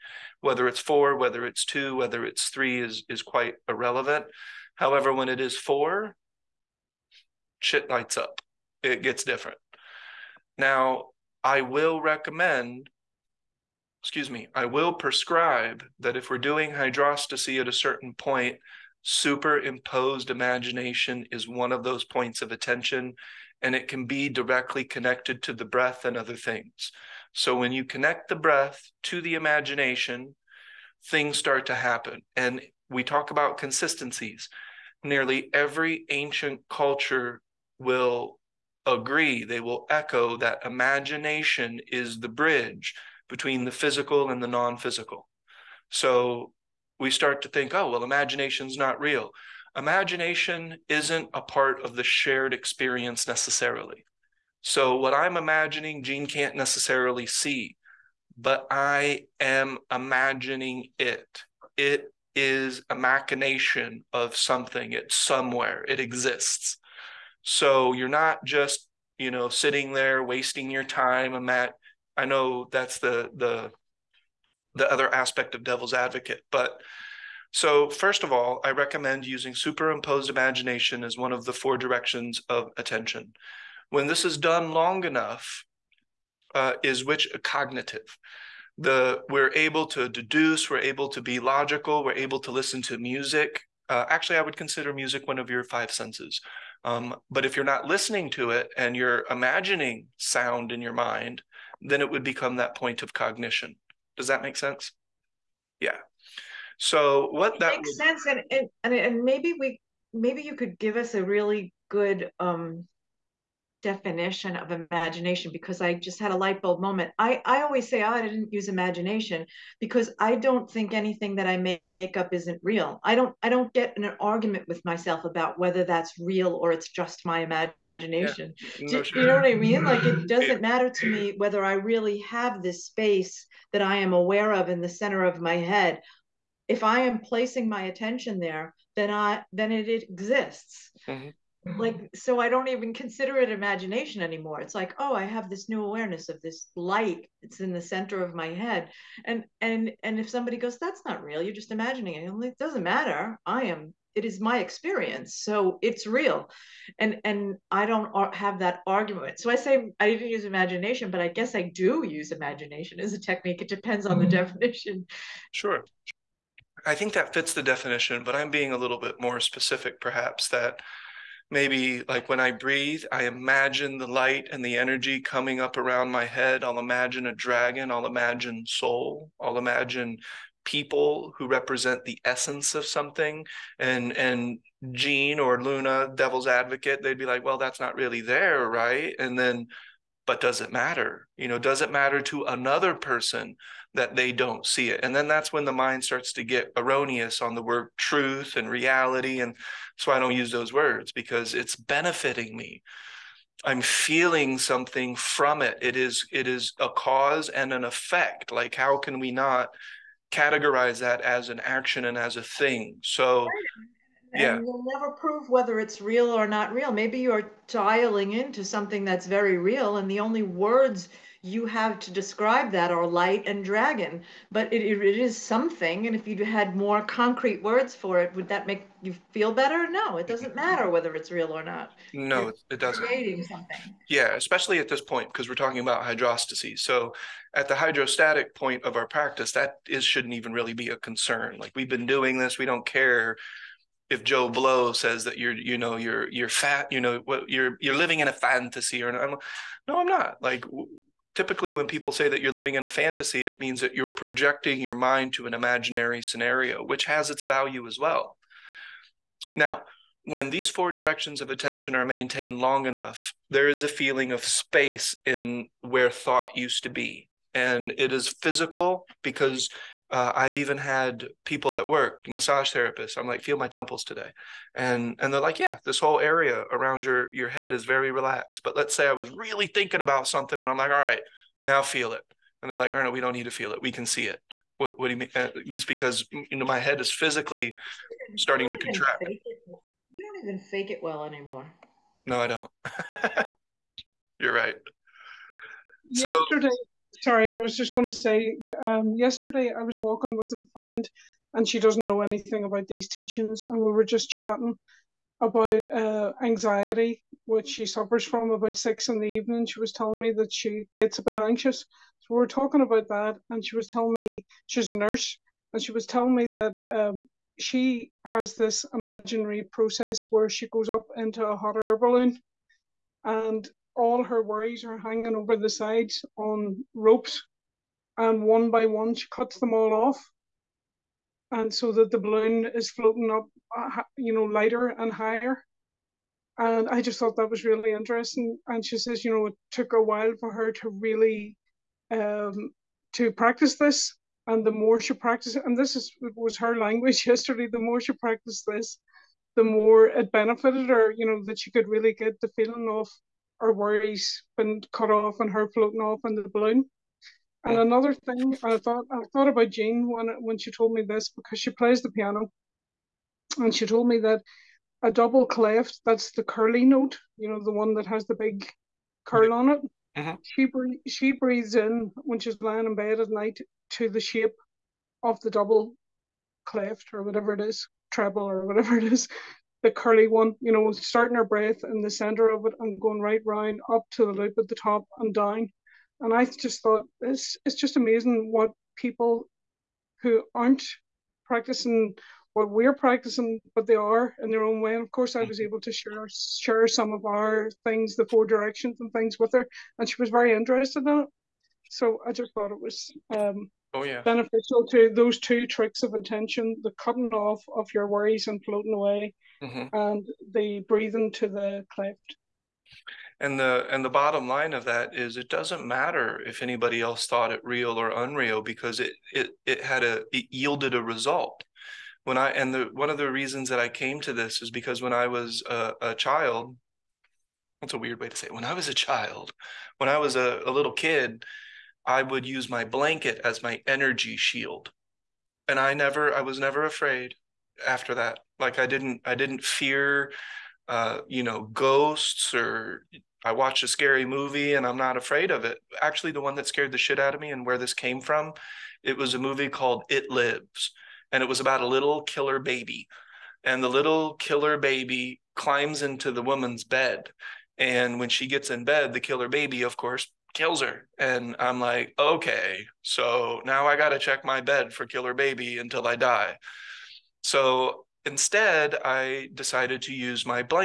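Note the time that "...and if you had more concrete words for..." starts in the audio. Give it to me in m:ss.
3:46.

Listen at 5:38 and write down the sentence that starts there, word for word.
And she says, you know, it took a while for her to really um, to practice this.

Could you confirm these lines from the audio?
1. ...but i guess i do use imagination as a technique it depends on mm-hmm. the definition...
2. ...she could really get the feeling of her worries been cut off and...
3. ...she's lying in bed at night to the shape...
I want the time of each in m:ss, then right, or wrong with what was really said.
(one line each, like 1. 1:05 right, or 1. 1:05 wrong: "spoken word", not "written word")
1. 2:41 right
2. 5:51 right
3. 6:12 right.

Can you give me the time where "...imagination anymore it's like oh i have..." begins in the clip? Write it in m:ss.
2:23.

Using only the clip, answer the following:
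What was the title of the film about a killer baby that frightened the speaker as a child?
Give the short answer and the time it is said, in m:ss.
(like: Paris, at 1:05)
It Lives, at 7:30.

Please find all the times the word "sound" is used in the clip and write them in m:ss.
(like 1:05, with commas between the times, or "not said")
1:40.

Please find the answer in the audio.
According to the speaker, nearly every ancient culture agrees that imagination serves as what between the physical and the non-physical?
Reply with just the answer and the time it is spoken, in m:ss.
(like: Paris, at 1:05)
the bridge, at 0:42.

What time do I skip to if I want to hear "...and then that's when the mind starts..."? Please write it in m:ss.
3:15.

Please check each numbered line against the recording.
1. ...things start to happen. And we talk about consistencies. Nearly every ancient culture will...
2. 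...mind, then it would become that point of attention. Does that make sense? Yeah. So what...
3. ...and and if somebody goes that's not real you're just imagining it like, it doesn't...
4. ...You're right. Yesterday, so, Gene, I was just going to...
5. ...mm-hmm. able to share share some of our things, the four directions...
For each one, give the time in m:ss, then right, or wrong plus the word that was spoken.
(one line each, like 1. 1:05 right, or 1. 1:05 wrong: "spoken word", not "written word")
1. 0:31 right
2. 1:40 wrong: "cognition", not "attention"
3. 2:29 right
4. 4:54 wrong: "Sorry", not "Gene"
5. 6:35 right.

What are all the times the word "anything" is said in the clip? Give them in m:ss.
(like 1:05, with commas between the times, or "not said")
2:00, 5:02.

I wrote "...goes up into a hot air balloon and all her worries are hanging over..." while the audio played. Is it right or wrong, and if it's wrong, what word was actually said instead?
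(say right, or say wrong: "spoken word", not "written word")
right.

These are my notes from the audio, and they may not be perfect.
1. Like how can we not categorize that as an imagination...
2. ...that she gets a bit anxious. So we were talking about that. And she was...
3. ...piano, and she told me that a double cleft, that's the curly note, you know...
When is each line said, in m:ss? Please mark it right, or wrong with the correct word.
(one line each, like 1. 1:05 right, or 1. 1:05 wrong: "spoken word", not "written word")
1. 3:28 wrong: "action", not "imagination"
2. 5:10 right
3. 6:02 right.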